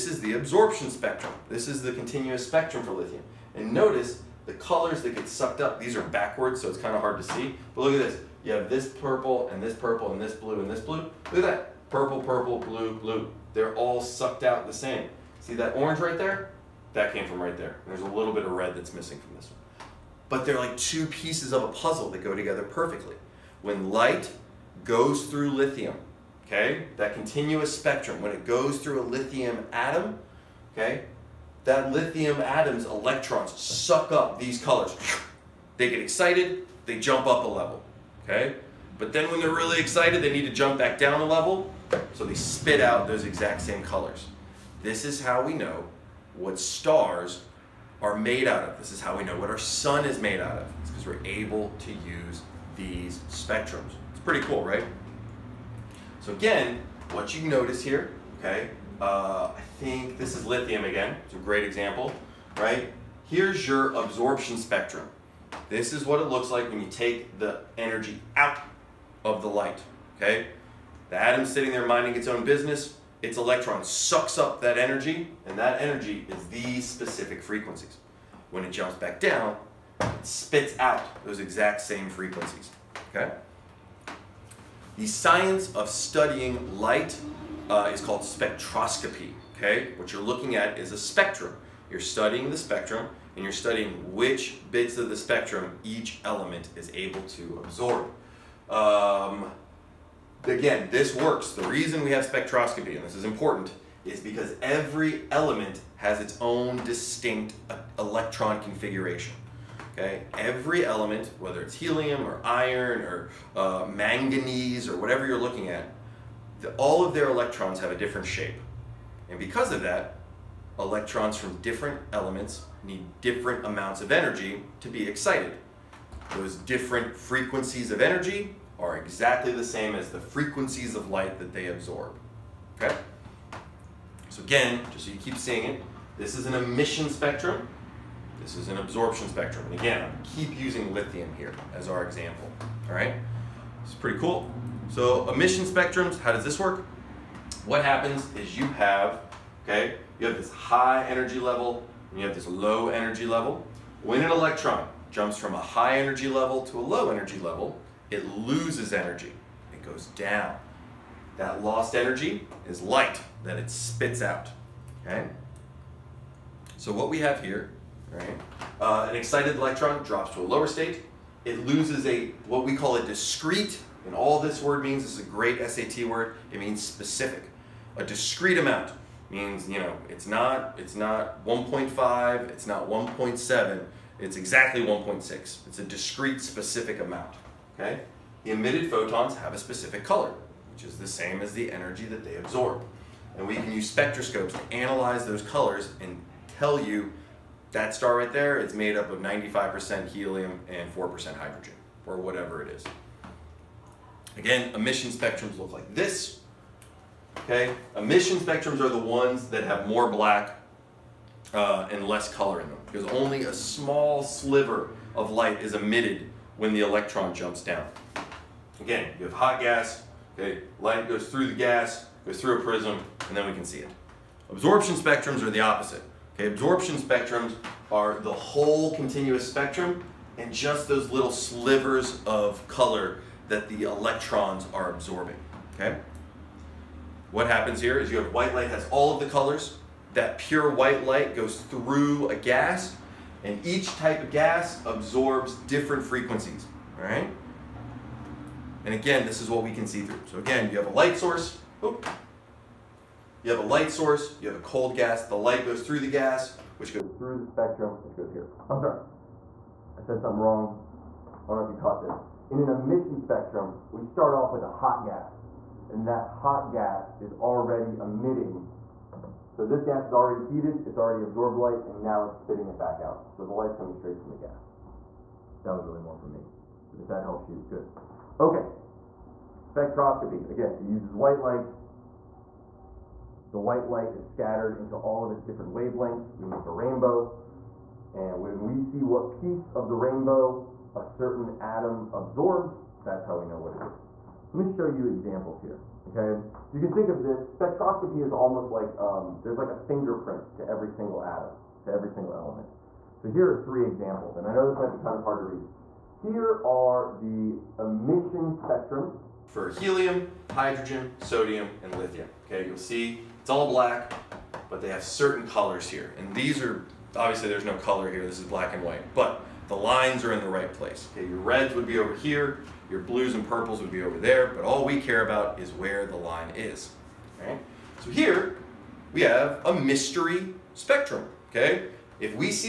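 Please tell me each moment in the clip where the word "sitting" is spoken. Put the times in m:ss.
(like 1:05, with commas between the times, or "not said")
1:11.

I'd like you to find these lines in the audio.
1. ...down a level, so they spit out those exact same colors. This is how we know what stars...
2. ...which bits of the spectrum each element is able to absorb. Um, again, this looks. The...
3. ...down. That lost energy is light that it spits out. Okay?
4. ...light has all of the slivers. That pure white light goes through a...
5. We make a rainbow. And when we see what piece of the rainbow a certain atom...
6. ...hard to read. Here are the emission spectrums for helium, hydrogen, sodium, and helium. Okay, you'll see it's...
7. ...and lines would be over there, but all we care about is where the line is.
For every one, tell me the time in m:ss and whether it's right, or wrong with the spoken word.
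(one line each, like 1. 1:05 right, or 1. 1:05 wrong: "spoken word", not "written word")
1. 0:40 right
2. 1:34 wrong: "works", not "looks"
3. 2:40 right
4. 3:58 wrong: "colors", not "slivers"
5. 4:46 right
6. 5:05 wrong: "lithium", not "helium"
7. 5:23 wrong: "purples", not "lines".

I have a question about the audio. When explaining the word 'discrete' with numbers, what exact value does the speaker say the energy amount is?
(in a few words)
1.6.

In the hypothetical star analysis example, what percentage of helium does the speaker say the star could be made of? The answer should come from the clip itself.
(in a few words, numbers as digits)
95%.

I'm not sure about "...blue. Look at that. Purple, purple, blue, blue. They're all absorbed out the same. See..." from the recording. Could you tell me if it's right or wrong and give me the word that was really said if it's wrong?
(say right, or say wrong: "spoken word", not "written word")
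wrong: "sucked", not "absorbed".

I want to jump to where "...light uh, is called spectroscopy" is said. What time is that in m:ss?
1:26.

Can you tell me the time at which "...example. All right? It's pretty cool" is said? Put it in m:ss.
2:22.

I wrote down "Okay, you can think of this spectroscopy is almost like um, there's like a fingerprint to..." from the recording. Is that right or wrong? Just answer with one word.
right.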